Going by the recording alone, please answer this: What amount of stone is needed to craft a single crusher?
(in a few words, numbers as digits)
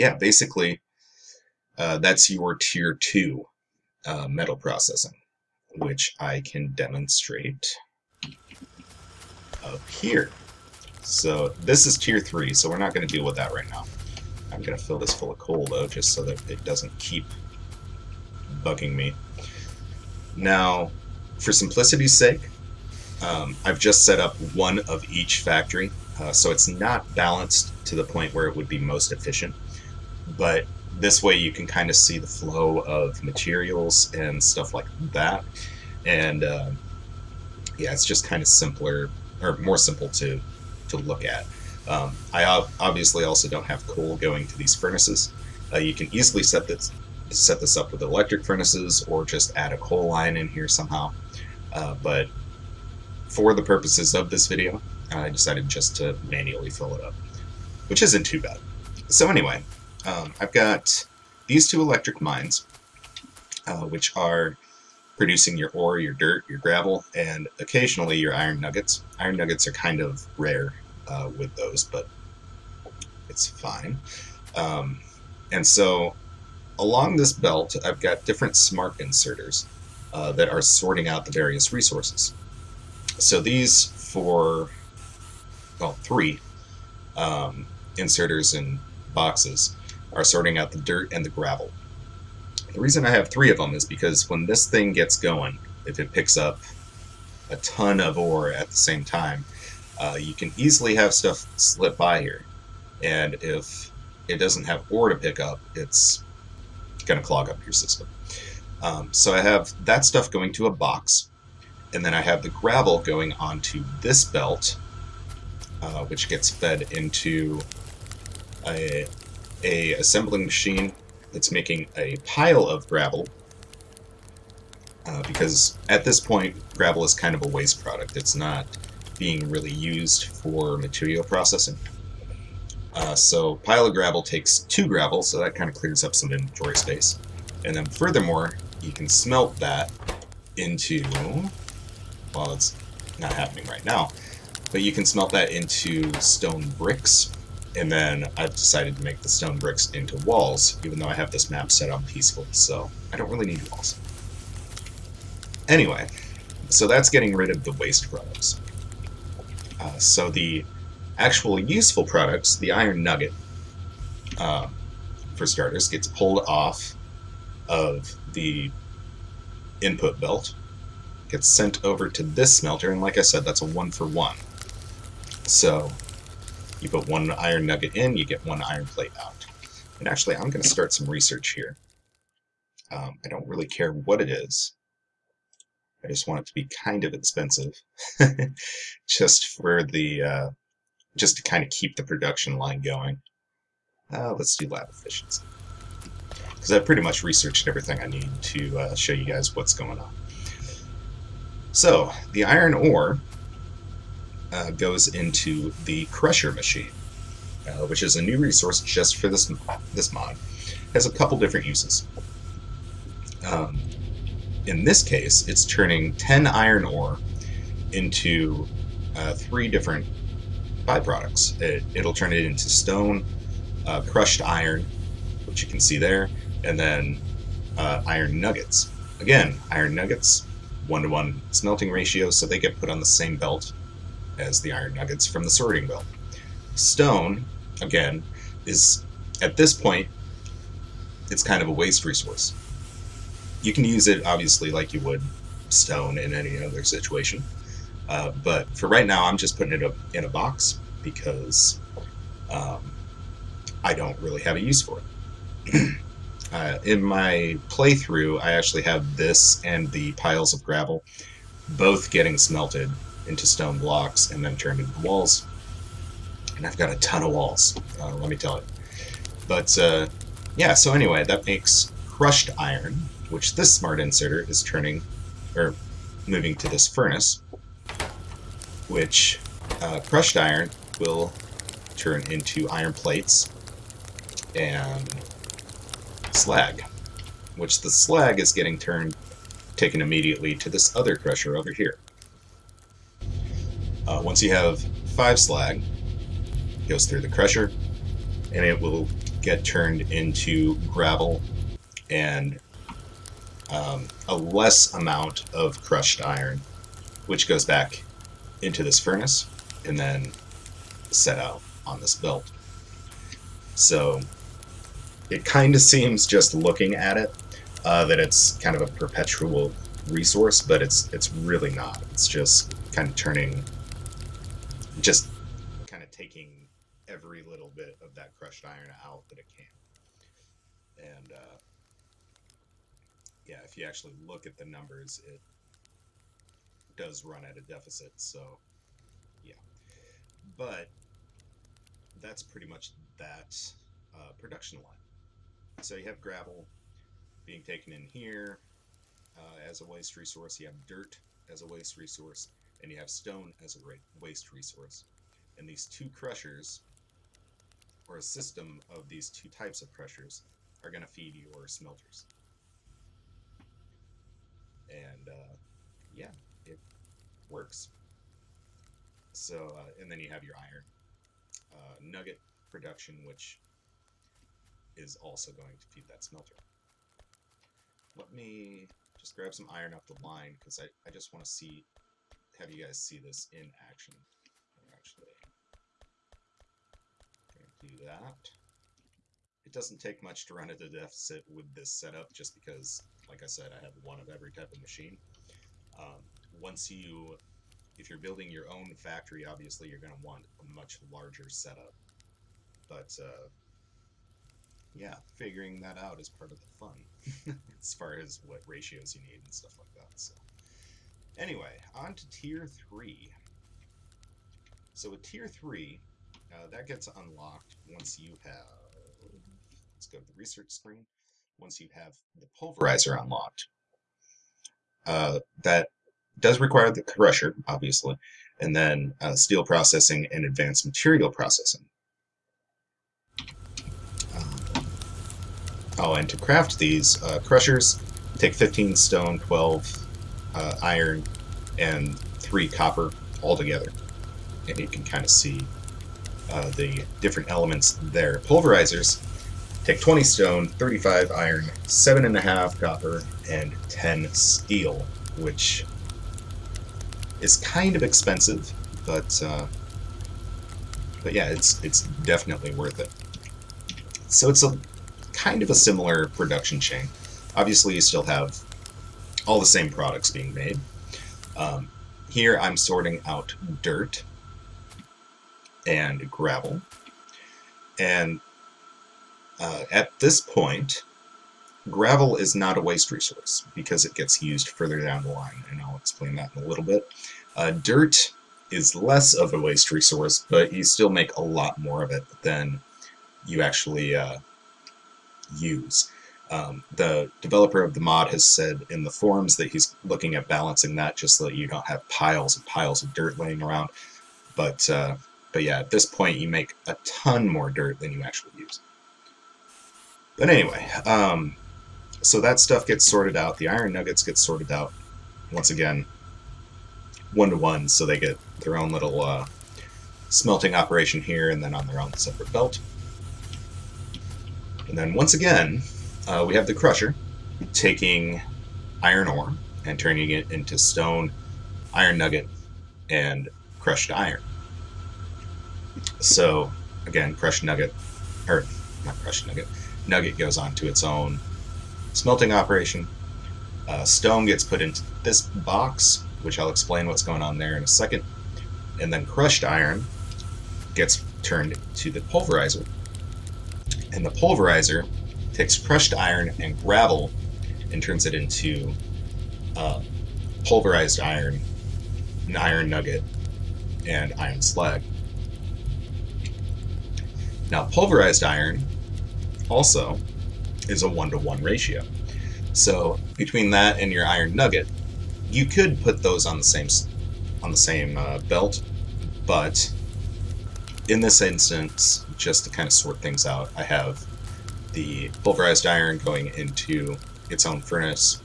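15.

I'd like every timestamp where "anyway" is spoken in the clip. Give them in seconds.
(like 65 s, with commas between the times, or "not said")
59 s, 155 s, 270 s, 411 s, 510 s.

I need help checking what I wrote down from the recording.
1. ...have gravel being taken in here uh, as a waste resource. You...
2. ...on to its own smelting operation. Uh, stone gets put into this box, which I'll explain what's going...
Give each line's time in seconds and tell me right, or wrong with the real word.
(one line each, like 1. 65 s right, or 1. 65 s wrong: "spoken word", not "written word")
1. 346 s right
2. 540 s right.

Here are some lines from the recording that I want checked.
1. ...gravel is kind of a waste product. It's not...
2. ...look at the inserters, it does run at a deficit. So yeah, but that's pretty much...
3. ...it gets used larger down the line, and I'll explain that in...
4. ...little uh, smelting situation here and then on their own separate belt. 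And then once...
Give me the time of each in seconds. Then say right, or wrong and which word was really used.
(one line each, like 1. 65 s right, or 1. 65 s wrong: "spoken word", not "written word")
1. 126 s right
2. 334 s wrong: "numbers", not "inserters"
3. 484 s wrong: "further", not "larger"
4. 518 s wrong: "operation", not "situation".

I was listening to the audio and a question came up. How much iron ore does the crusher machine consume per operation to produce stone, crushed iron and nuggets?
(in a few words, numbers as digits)
10.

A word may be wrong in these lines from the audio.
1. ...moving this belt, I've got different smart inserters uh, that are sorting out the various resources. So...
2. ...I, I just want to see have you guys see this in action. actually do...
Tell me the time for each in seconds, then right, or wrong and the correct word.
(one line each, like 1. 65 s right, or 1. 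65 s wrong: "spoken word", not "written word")
1. 76 s wrong: "along", not "moving"
2. 380 s right.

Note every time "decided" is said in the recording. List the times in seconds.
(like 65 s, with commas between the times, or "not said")
55 s, 148 s.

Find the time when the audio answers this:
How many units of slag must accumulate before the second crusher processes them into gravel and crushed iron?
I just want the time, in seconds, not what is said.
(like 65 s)
295 s.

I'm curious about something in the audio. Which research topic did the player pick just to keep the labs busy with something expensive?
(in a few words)
Lab efficiency.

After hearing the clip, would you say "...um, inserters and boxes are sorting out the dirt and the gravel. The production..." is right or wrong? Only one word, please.
wrong.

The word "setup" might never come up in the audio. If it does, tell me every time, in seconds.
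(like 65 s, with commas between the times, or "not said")
391 s, 401 s.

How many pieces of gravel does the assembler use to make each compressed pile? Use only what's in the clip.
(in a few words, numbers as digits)
2.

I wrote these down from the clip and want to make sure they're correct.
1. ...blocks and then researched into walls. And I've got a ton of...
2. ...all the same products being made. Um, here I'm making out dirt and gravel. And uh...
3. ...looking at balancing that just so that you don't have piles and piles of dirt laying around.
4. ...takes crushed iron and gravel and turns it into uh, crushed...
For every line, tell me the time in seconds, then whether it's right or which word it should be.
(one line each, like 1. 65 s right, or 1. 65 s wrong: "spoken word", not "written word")
1. 263 s wrong: "turned", not "researched"
2. 469 s wrong: "sorting", not "making"
3. 500 s right
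4. 555 s wrong: "pulverized", not "crushed".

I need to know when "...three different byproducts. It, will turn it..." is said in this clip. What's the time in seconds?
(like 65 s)
219 s.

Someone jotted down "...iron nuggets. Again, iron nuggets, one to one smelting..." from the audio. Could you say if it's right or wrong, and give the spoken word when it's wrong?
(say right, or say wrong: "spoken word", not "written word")
right.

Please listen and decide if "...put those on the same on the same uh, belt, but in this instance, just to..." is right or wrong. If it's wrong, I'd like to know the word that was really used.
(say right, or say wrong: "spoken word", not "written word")
right.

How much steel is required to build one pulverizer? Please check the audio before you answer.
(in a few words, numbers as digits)
10.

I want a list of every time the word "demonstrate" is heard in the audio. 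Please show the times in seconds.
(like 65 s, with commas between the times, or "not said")
6 s.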